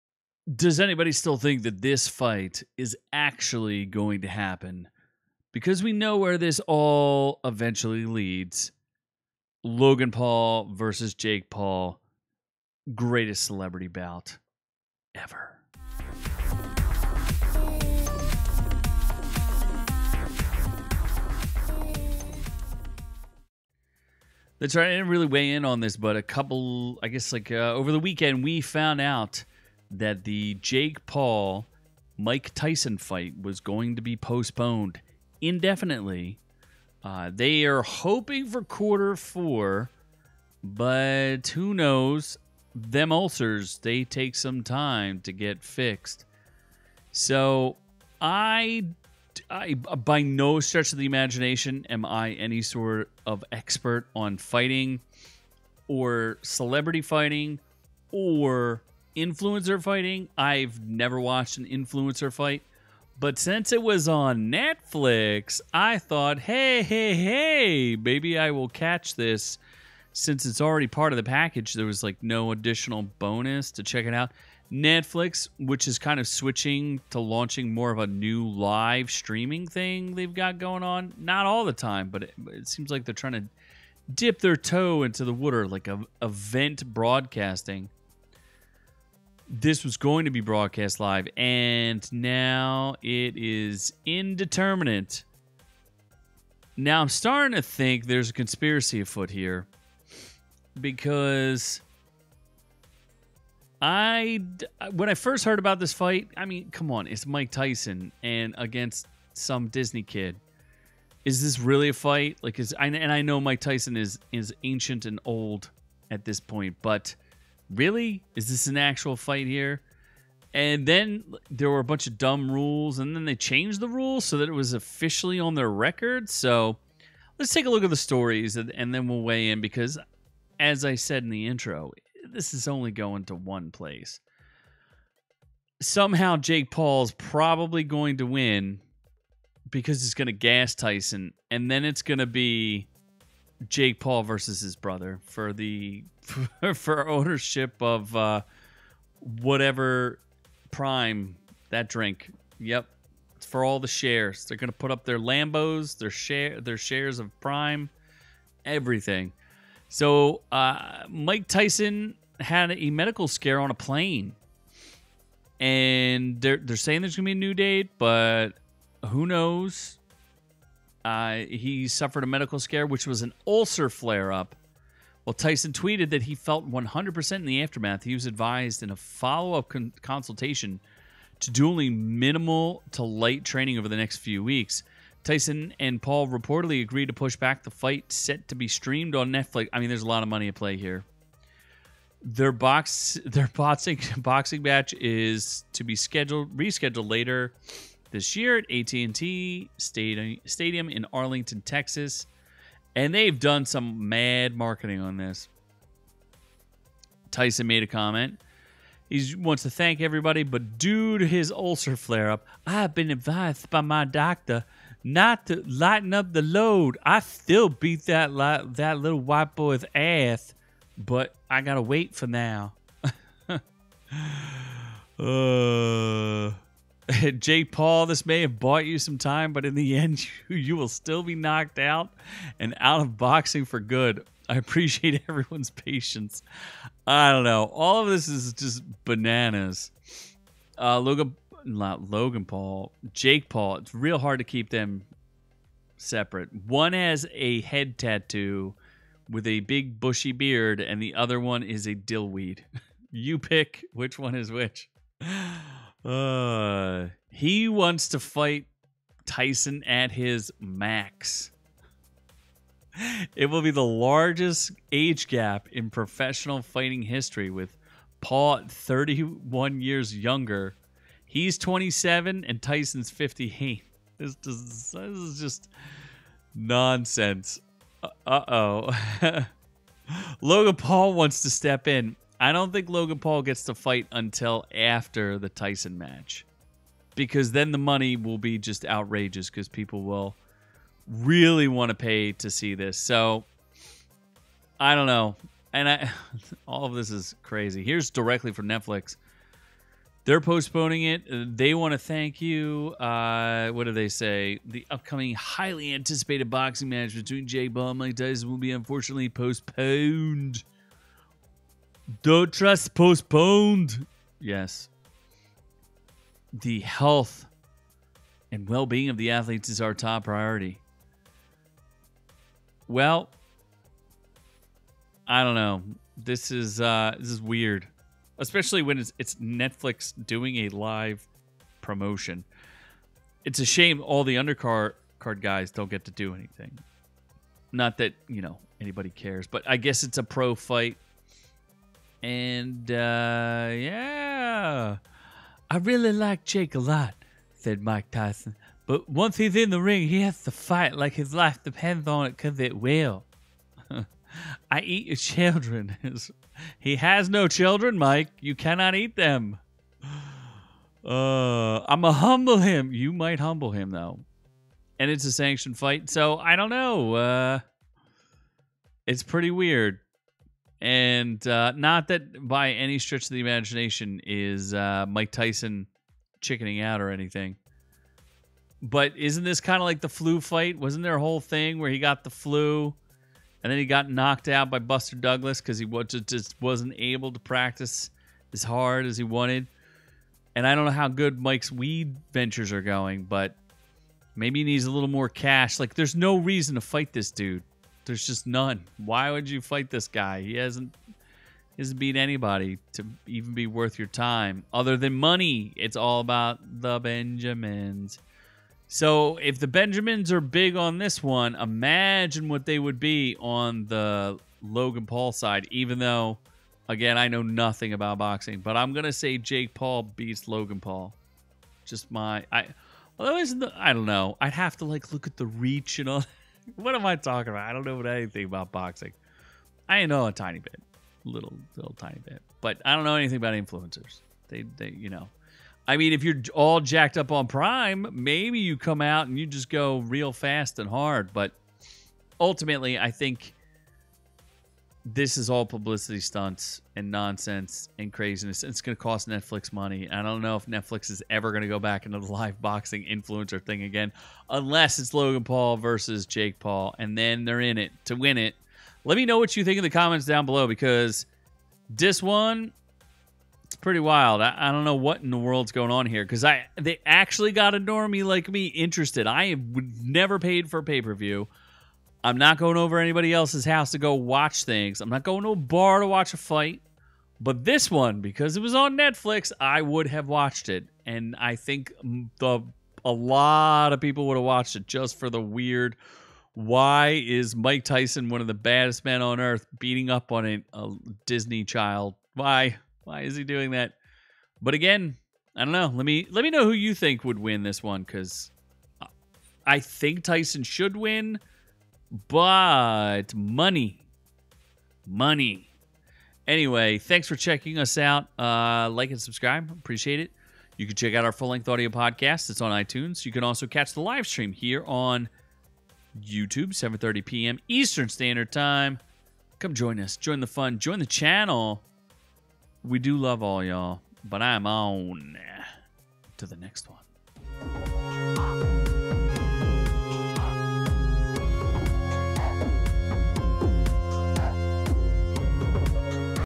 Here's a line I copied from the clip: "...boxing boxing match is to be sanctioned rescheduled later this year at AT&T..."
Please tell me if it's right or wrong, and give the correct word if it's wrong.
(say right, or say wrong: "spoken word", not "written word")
wrong: "scheduled", not "sanctioned".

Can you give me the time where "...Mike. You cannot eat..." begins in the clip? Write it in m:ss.
5:57.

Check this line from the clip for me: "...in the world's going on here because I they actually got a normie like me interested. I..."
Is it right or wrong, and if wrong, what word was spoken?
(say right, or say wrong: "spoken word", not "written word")
right.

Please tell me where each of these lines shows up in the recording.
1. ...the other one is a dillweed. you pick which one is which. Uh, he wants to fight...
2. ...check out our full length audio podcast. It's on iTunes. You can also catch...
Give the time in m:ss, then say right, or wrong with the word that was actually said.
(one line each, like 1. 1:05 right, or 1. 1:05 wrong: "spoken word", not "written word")
1. 4:11 right
2. 8:30 right.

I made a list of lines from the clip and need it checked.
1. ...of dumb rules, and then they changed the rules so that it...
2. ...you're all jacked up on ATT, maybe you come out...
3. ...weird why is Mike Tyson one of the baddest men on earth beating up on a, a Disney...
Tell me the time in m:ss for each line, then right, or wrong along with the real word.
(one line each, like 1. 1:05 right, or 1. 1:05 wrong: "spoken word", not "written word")
1. 2:02 right
2. 7:16 wrong: "Prime", not "ATT"
3. 8:05 right.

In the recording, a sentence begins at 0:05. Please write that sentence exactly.
Because we know where this all eventually leads.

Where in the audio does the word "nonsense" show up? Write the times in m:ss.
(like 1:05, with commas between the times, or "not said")
4:36, 7:27.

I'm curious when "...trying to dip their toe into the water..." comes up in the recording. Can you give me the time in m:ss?
1:23.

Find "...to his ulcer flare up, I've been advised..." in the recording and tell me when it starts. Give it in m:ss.
3:31.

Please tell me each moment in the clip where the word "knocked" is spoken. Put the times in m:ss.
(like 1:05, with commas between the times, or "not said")
3:51, 6:24.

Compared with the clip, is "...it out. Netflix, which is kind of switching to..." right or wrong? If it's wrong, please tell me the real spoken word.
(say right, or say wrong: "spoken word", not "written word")
right.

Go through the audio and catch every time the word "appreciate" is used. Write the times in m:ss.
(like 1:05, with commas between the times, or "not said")
3:54, 8:29.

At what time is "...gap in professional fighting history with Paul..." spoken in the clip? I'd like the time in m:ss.
4:25.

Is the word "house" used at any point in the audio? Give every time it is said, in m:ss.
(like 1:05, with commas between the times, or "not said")
7:53.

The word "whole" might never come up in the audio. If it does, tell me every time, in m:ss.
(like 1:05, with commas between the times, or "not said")
6:21.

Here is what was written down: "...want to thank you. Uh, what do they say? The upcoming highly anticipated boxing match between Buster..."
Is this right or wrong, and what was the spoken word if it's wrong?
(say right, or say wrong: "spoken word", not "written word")
wrong: "Jake", not "Buster".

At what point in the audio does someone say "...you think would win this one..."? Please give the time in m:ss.
8:16.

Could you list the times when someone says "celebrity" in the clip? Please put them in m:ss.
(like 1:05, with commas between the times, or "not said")
0:13, 0:56.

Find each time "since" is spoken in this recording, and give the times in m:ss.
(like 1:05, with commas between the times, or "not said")
1:03, 1:10.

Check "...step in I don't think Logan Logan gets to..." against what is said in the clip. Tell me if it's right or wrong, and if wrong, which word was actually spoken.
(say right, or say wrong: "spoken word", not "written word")
wrong: "Paul", not "Logan".